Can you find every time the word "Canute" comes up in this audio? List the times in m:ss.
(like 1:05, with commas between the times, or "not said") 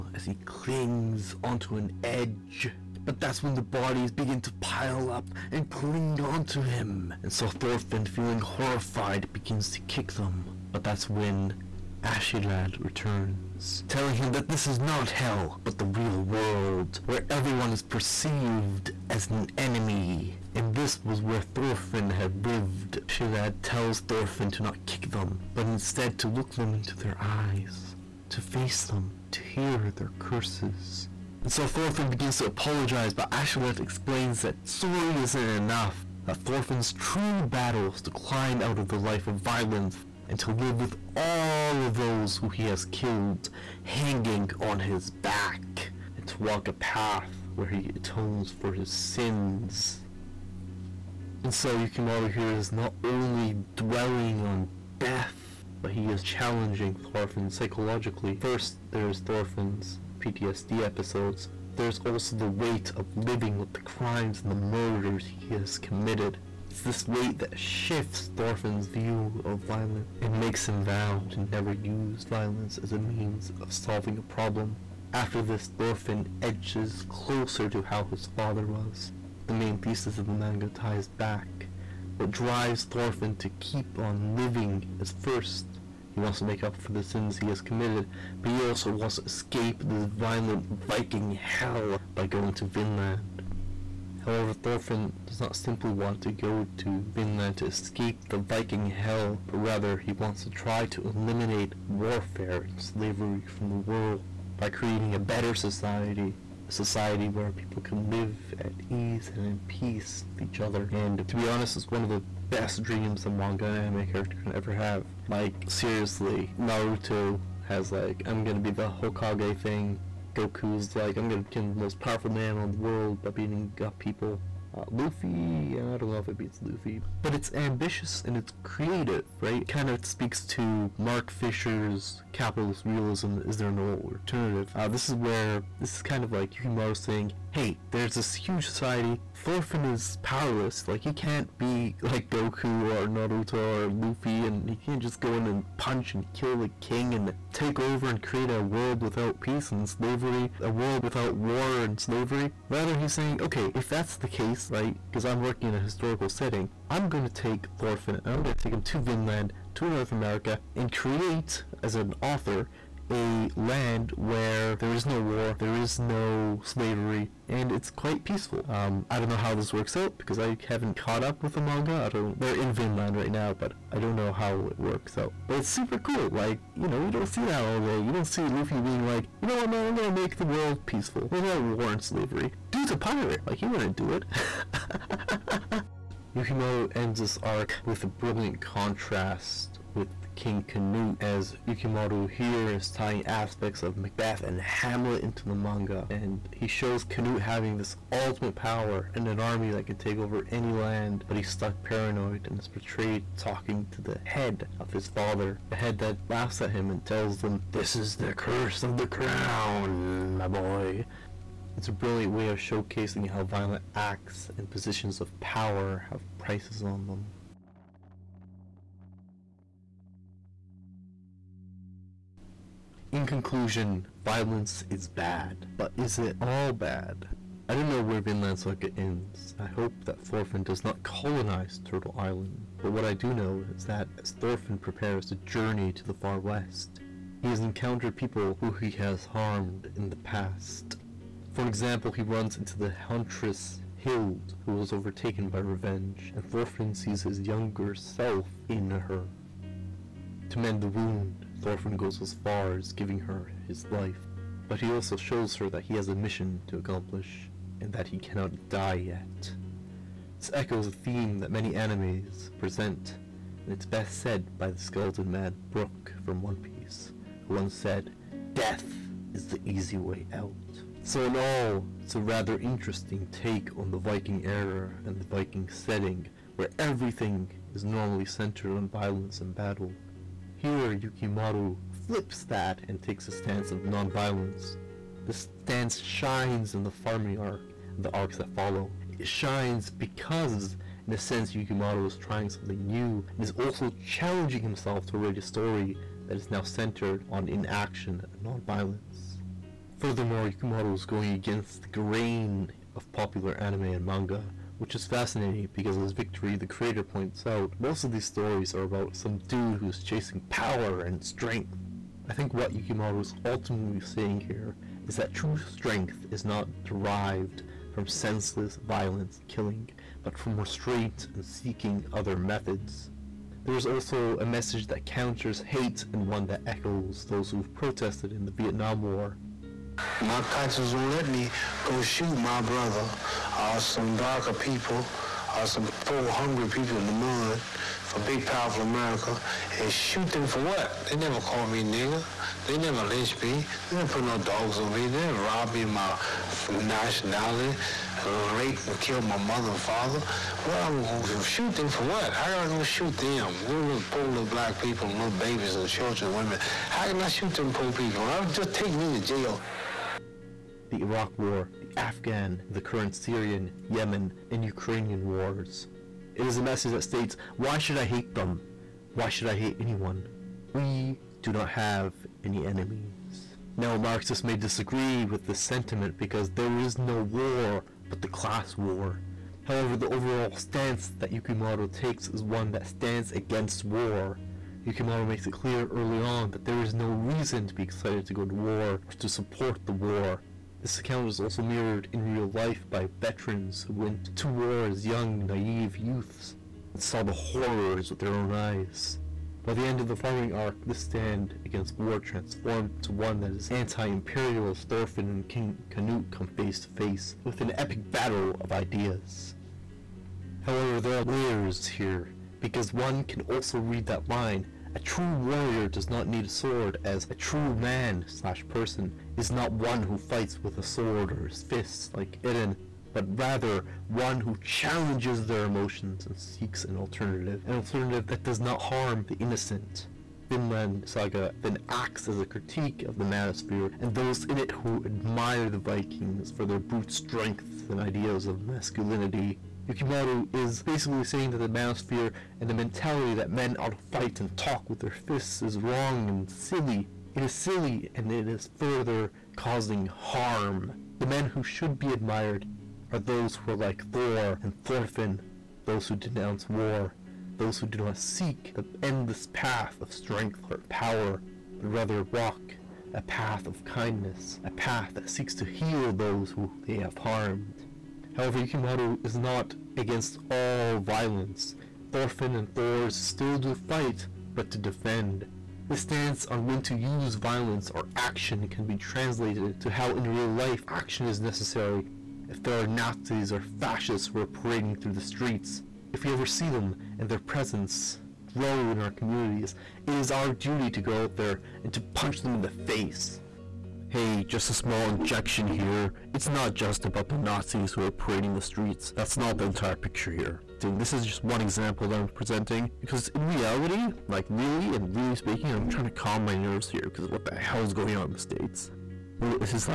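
3:10, 3:17, 6:45.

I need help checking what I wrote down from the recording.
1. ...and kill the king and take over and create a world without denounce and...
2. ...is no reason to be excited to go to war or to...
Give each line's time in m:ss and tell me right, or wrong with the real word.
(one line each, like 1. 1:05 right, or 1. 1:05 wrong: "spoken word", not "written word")
1. 2:26 wrong: "peace", not "denounce"
2. 6:26 right.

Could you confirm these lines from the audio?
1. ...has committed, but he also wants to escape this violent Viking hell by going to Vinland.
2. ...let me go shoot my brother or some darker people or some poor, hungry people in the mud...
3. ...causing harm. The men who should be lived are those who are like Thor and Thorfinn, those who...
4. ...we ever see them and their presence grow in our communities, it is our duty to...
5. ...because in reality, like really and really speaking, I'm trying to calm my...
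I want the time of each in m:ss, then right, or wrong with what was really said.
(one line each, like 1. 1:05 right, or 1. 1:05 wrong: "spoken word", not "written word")
1. 1:27 right
2. 5:31 right
3. 7:29 wrong: "admired", not "lived"
4. 8:06 right
5. 8:22 right.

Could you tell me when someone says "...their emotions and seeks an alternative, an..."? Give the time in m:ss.
7:05.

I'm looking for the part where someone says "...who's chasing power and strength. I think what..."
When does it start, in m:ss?
5:09.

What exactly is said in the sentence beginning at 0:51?
And so Yukimura here is not only dwelling on death, but he is challenging Thorfinn psychologically.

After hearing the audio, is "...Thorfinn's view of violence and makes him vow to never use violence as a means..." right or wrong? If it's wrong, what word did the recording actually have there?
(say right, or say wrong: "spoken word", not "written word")
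right.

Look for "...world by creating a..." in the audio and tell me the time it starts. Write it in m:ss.
1:43.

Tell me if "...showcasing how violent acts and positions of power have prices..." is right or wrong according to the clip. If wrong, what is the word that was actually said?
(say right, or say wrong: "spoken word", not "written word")
right.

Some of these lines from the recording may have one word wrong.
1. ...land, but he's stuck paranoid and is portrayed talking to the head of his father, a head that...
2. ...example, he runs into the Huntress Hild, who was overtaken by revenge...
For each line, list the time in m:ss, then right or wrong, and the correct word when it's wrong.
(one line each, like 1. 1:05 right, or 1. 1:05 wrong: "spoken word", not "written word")
1. 3:20 right
2. 4:01 right.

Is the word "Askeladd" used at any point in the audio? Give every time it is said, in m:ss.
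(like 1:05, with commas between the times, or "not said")
0:12, 0:23, 0:33.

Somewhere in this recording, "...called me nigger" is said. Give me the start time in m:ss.
5:41.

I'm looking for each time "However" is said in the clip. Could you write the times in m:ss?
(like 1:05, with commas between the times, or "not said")
1:34, 6:19, 6:50, 7:48.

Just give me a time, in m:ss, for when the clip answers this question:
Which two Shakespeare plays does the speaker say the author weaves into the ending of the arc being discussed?
3:13.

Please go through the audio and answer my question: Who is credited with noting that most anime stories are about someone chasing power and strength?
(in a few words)
Victory the creator.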